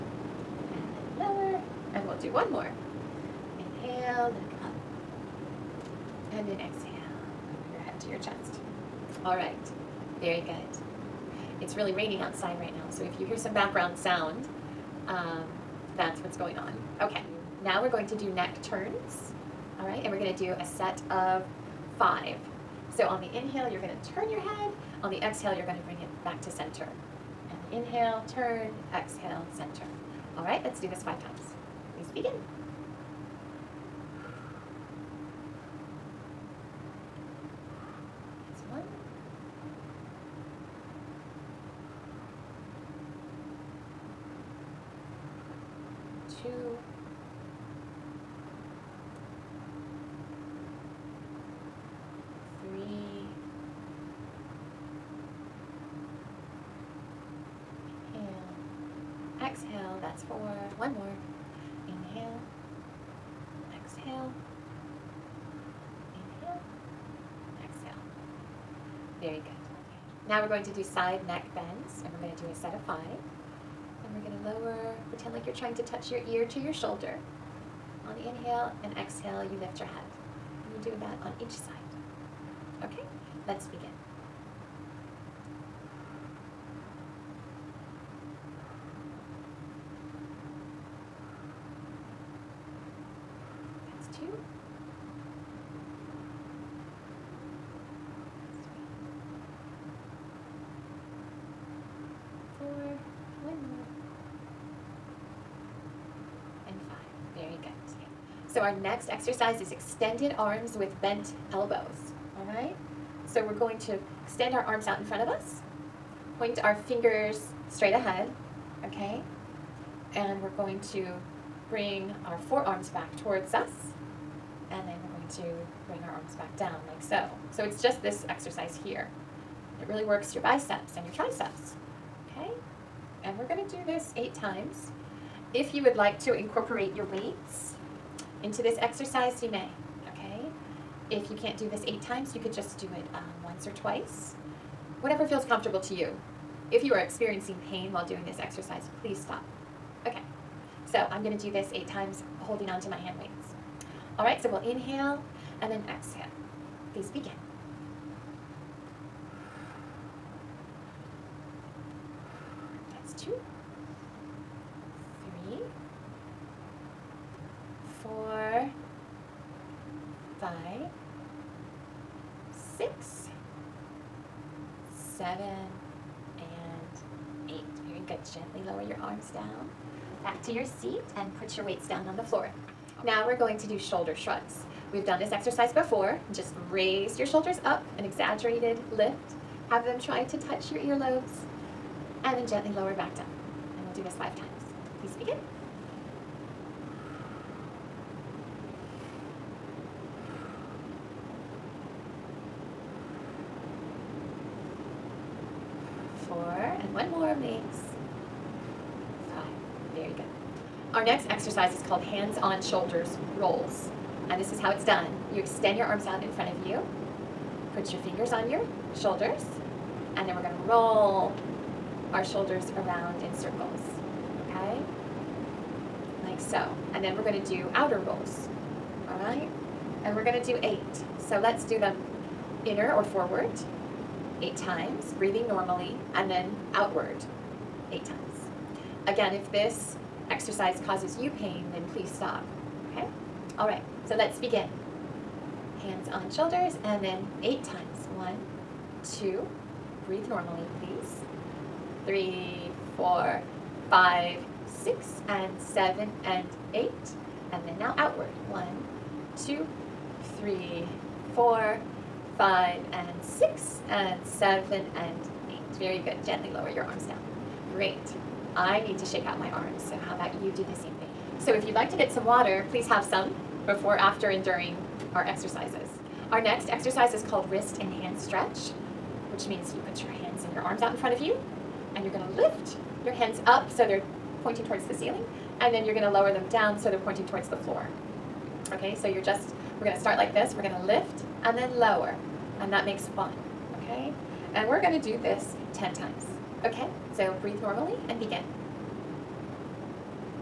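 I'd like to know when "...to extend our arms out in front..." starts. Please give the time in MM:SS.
01:53.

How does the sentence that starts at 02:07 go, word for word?
So it's just this exercise here.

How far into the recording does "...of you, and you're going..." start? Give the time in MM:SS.
04:41.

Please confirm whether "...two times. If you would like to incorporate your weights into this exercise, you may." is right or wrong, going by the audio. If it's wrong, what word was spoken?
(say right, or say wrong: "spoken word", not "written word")
wrong: "eight", not "two".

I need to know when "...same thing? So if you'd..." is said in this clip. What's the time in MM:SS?
04:30.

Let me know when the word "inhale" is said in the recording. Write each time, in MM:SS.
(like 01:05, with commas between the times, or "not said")
00:03, 00:23, 00:27, 01:18, 02:34.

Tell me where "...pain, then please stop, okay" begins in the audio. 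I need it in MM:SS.
04:01.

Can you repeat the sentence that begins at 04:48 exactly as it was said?
Okay, so you're just, we're going to start like this.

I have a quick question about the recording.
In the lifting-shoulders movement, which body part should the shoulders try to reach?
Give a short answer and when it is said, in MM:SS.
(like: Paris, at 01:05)
Earlobes, at 03:10.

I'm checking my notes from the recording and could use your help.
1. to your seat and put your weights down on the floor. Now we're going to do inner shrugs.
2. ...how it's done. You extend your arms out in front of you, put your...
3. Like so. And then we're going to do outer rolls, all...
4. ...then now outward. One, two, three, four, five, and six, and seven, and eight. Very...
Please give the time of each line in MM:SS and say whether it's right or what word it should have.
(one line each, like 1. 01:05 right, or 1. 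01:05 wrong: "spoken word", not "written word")
1. 03:00 wrong: "shoulder", not "inner"
2. 03:34 right
3. 03:46 right
4. 04:17 right.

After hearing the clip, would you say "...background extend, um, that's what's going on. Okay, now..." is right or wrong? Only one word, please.
wrong.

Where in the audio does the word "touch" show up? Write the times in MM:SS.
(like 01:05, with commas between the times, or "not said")
01:15, 03:10.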